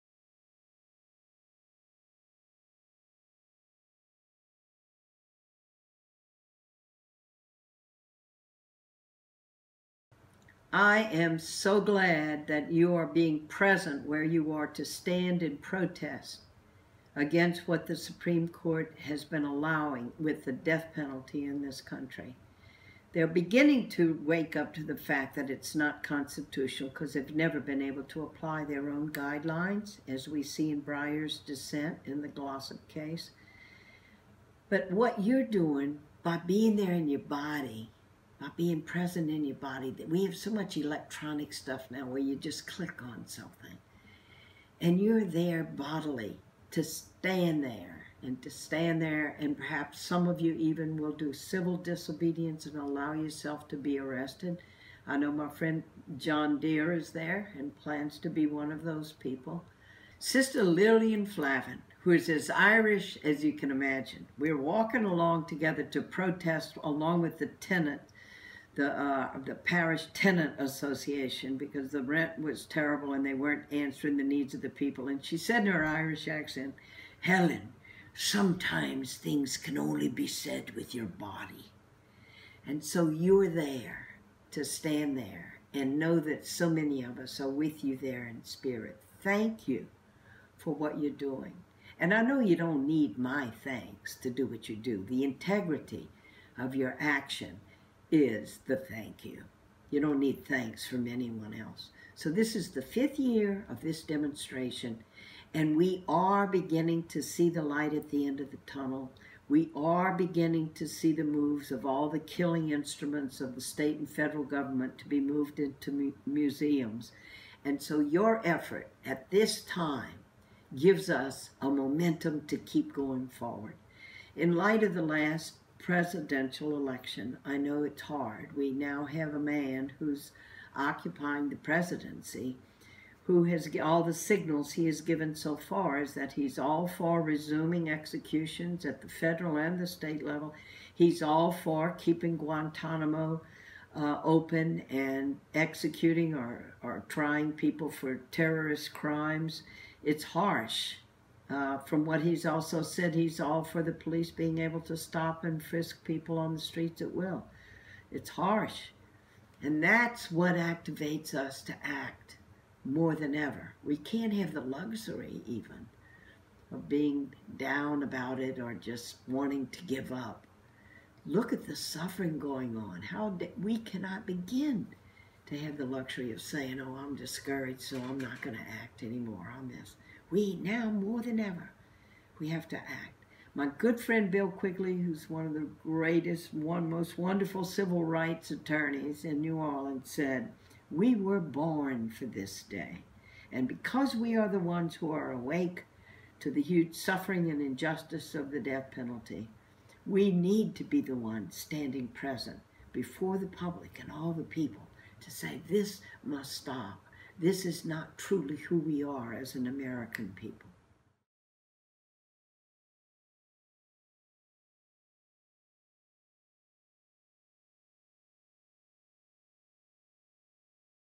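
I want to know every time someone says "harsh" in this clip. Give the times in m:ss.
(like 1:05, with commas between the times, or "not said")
2:30, 2:38.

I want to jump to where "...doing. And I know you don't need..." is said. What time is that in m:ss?
1:31.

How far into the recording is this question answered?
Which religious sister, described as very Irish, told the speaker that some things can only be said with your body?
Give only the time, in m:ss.
1:00.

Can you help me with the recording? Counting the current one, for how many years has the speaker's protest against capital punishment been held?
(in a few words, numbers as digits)
5.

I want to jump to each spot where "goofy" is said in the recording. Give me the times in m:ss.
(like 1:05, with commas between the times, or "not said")
not said.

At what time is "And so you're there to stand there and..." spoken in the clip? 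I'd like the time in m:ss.
1:22.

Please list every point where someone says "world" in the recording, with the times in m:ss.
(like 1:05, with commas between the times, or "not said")
not said.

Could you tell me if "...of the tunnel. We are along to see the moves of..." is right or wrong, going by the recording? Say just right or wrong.
wrong.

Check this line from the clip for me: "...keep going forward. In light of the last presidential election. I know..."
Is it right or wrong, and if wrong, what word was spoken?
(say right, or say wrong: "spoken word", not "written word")
right.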